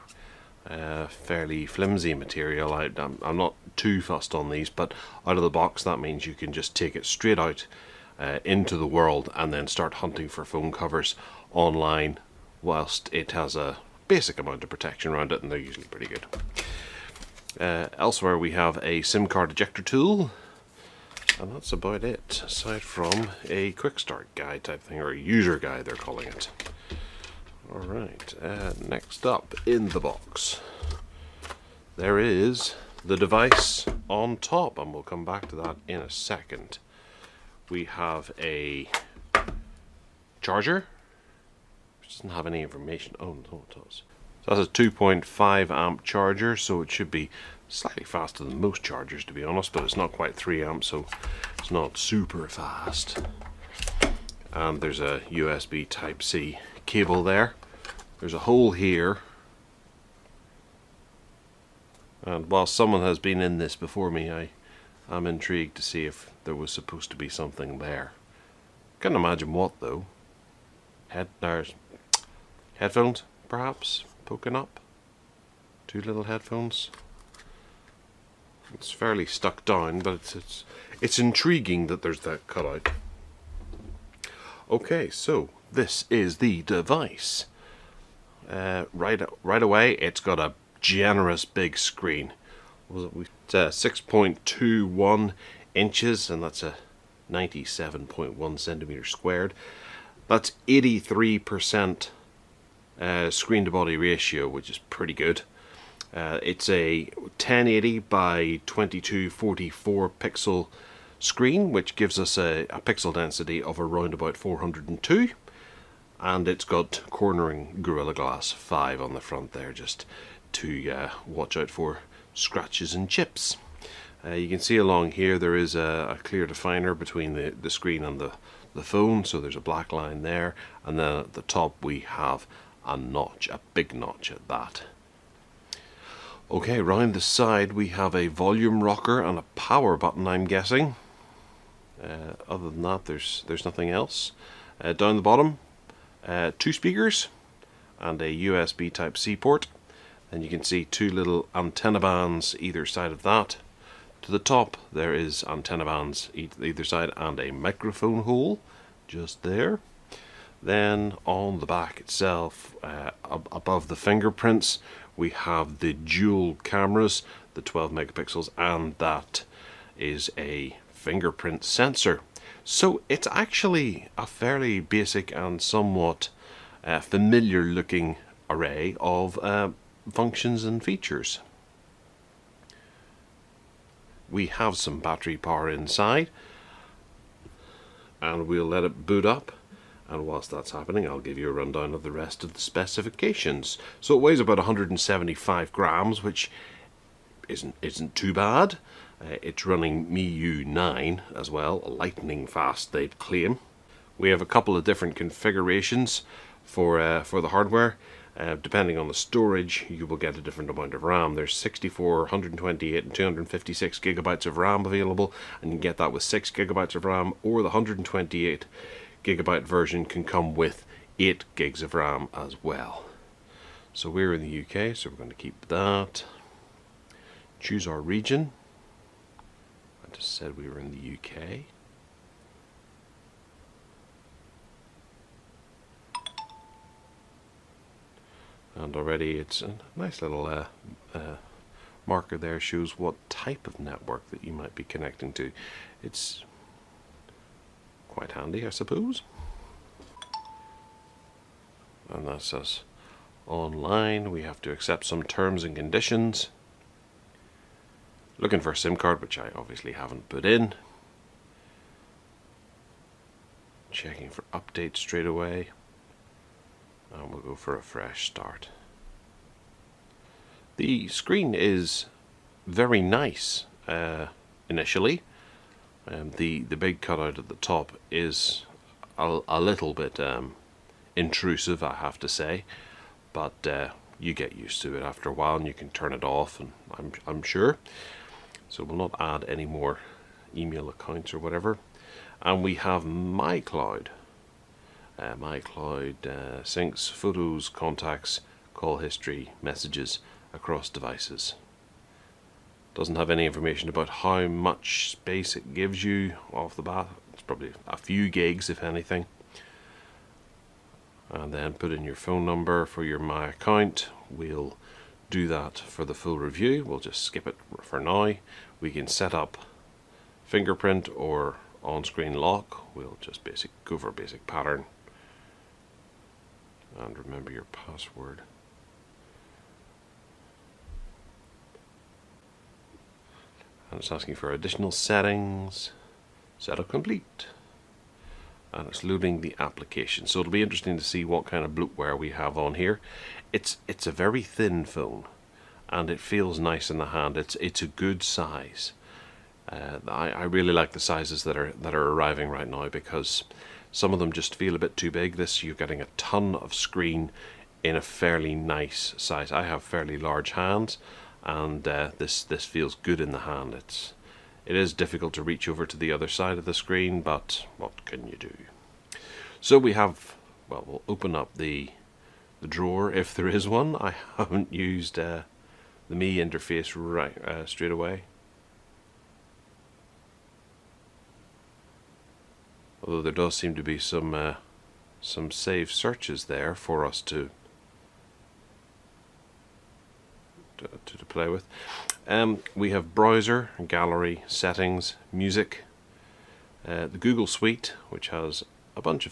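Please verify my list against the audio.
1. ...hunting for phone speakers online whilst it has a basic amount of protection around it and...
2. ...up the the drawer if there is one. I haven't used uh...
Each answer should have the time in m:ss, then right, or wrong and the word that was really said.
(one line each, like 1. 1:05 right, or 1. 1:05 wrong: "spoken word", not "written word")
1. 0:09 wrong: "covers", not "speakers"
2. 6:11 right.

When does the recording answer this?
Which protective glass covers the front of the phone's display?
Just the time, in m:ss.
1:57.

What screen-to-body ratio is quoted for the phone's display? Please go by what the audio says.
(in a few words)
83%.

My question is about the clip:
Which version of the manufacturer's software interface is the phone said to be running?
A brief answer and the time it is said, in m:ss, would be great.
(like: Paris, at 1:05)
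MIUI 9, at 3:20.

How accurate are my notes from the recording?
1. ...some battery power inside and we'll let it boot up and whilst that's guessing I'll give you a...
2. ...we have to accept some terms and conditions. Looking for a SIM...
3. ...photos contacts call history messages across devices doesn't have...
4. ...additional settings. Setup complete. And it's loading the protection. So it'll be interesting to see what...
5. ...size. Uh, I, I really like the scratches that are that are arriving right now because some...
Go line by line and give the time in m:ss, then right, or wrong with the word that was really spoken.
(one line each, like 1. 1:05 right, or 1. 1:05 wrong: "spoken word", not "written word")
1. 3:04 wrong: "happening", not "guessing"
2. 4:14 right
3. 4:57 right
4. 5:34 wrong: "application", not "protection"
5. 5:48 wrong: "sizes", not "scratches".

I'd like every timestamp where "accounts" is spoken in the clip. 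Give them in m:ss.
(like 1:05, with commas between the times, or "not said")
4:50, 5:13.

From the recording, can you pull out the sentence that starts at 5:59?
I have fairly large hands, and uh, this this feels good in the hand.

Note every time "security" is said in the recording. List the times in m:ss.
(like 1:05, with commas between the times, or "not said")
not said.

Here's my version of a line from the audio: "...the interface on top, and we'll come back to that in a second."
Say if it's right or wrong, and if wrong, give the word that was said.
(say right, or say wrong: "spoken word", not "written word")
wrong: "device", not "interface".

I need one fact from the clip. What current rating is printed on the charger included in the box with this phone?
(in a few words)
2.5 amp.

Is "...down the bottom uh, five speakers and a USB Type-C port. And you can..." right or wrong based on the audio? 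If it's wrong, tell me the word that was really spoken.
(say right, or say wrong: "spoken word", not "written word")
wrong: "two", not "five".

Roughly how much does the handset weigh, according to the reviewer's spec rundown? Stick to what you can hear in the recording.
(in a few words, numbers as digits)
175 grams.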